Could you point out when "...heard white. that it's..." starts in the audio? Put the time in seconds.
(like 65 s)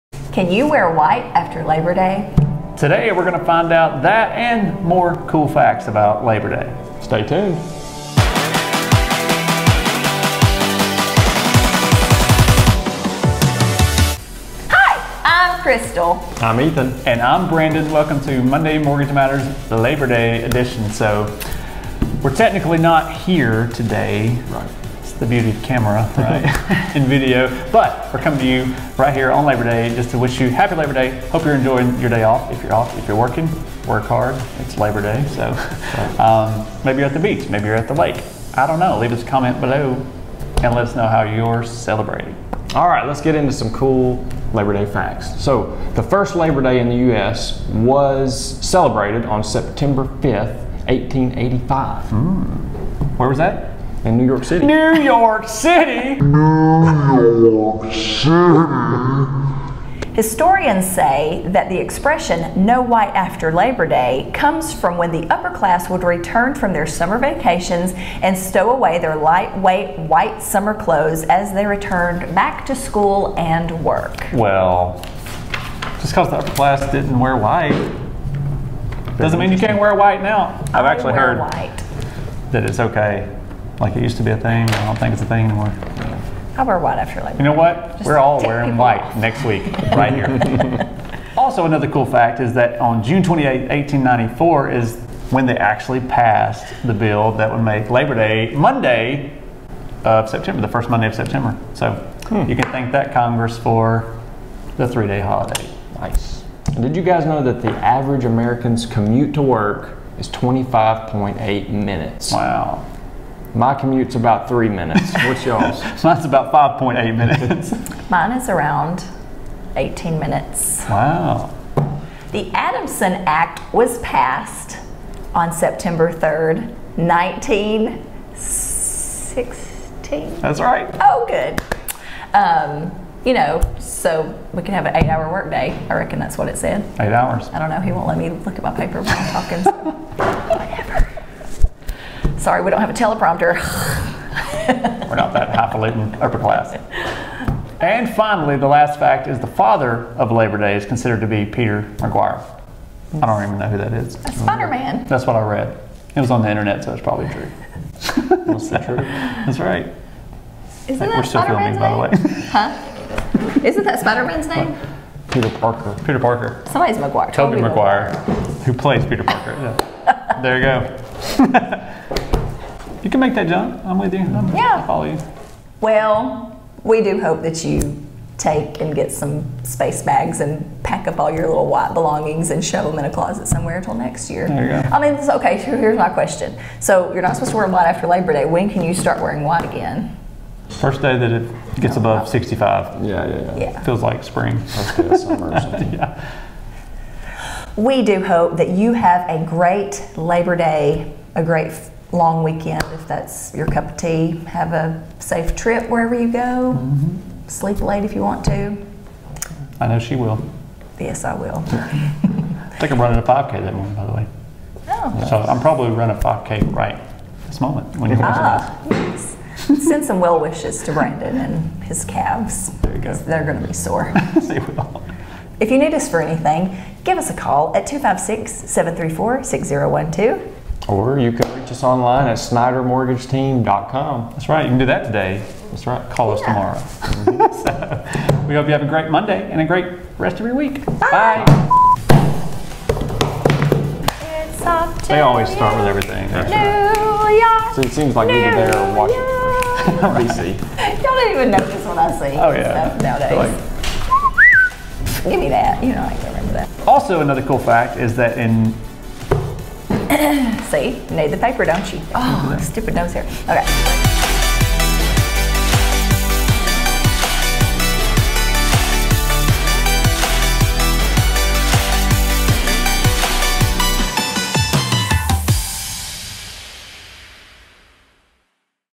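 81 s.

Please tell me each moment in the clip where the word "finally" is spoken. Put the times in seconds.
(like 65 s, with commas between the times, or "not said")
148 s.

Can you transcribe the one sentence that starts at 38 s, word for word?
Leave us a comment below and let us know how you're celebrating.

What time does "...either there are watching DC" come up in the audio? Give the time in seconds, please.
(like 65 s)
248 s.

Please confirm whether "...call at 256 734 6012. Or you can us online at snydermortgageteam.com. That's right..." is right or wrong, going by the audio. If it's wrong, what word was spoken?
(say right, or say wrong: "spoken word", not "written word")
right.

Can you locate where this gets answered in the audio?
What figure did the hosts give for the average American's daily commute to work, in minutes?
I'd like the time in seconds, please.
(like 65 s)
110 s.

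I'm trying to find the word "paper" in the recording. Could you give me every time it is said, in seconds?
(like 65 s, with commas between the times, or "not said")
138 s, 261 s.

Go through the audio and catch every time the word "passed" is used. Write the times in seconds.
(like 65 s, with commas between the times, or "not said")
96 s, 123 s.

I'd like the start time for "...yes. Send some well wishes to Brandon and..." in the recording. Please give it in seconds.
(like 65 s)
218 s.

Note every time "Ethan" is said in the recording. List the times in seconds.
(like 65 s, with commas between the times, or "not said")
16 s.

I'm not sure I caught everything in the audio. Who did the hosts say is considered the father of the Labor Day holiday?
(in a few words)
Peter McGuire.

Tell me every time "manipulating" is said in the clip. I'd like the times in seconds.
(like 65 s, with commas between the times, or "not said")
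not said.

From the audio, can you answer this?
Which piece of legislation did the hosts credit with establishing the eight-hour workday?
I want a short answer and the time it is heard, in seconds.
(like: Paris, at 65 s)
The Adamson Act, at 122 s.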